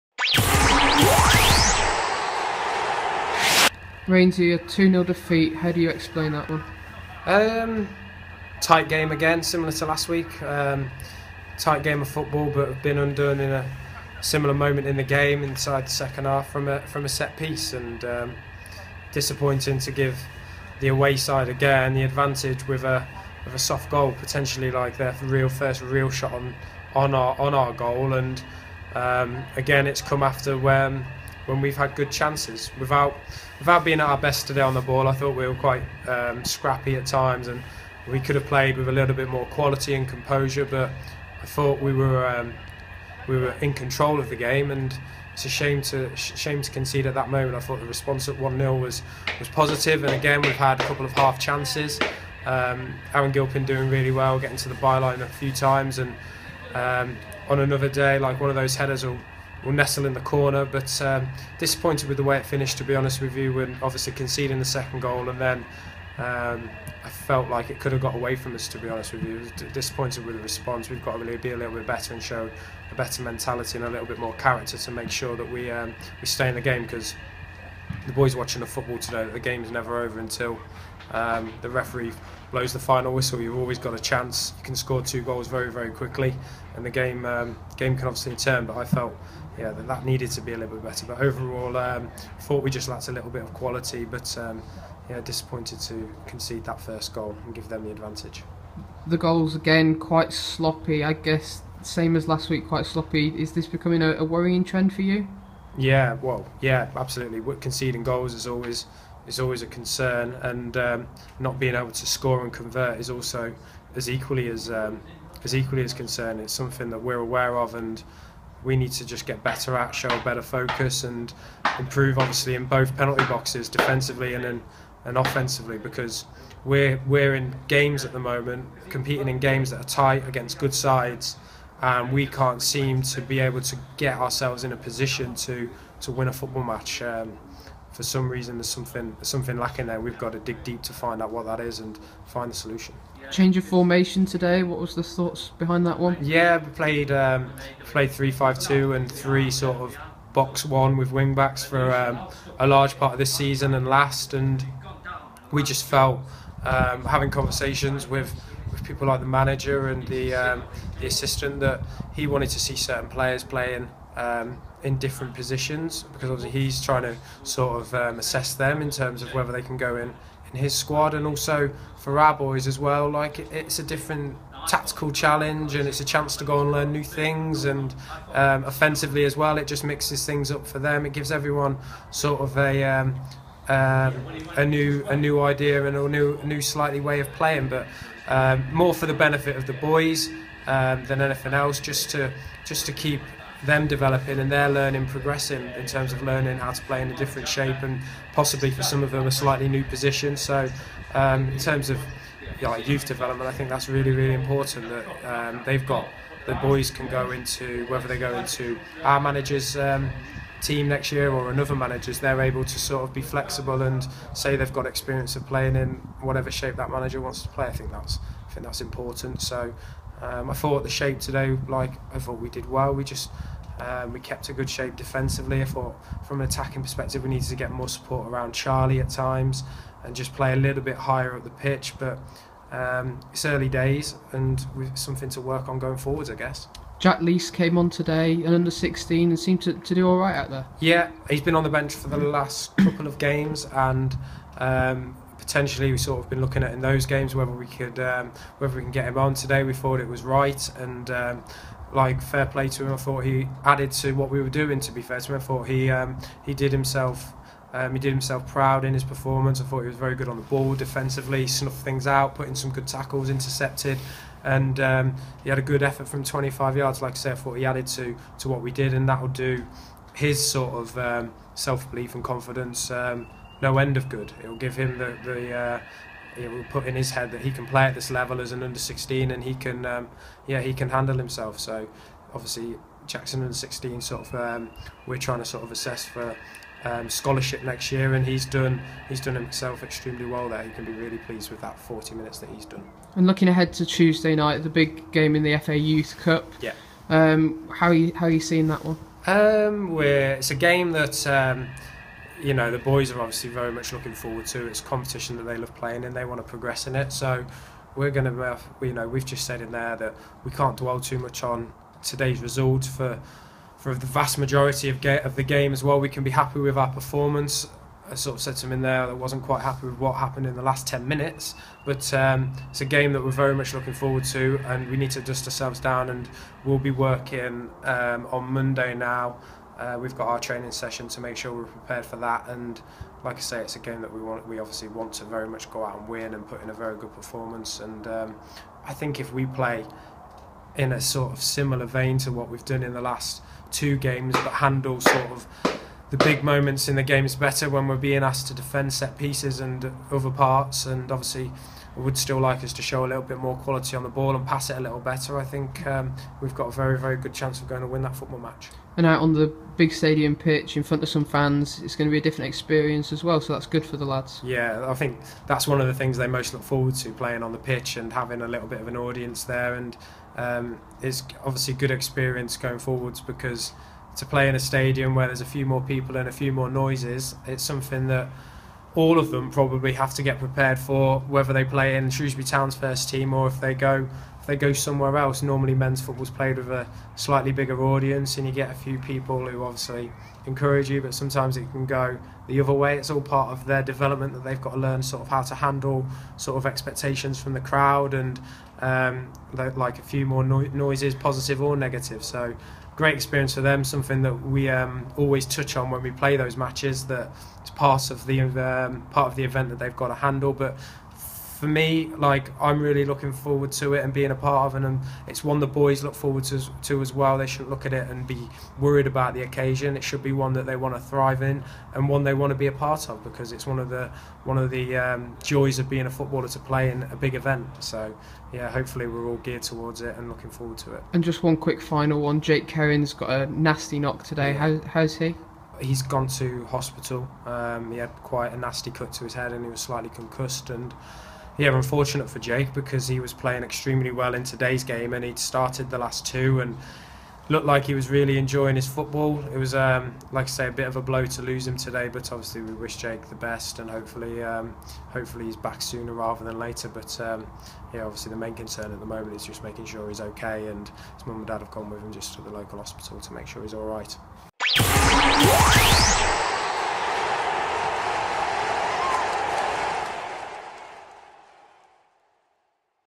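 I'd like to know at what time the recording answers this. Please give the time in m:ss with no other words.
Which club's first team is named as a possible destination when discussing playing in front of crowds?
6:22.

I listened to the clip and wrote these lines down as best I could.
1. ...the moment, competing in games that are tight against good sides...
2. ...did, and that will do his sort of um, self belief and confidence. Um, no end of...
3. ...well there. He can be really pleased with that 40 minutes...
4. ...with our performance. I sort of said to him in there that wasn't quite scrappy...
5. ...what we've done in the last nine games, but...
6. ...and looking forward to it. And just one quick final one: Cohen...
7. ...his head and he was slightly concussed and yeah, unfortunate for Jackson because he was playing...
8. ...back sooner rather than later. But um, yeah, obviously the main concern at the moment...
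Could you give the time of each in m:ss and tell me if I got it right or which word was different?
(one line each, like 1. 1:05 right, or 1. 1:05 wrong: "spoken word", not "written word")
1. 2:08 right
2. 4:28 right
3. 4:50 right
4. 5:16 wrong: "happy", not "scrappy"
5. 5:42 wrong: "two", not "nine"
6. 7:10 wrong: "Jake", not "Cohen"
7. 7:19 wrong: "Jake", not "Jackson"
8. 7:35 right.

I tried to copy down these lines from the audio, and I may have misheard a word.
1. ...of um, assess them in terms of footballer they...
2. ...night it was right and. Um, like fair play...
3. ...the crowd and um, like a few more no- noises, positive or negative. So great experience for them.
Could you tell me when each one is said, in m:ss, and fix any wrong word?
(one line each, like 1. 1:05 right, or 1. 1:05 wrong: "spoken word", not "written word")
1. 2:47 wrong: "whether", not "footballer"
2. 4:09 wrong: "thought", not "night"
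3. 6:37 right.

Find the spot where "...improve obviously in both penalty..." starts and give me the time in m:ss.
2:01.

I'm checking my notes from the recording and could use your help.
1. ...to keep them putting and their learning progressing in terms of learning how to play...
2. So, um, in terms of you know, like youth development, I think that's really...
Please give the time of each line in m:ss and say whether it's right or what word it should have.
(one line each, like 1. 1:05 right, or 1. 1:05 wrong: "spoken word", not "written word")
1. 3:12 wrong: "developing", not "putting"
2. 3:20 right.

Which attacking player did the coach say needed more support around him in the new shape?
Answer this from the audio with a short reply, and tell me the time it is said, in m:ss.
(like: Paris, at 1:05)
Charlie, at 3:48.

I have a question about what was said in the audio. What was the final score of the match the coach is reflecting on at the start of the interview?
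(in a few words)
2-0.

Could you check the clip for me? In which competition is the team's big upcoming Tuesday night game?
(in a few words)
FA Youth Cup.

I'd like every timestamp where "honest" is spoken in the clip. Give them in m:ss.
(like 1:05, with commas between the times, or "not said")
1:02, 1:08.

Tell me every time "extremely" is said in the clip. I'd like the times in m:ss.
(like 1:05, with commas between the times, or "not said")
4:49, 7:23.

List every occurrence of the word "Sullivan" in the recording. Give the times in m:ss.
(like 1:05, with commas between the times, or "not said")
not said.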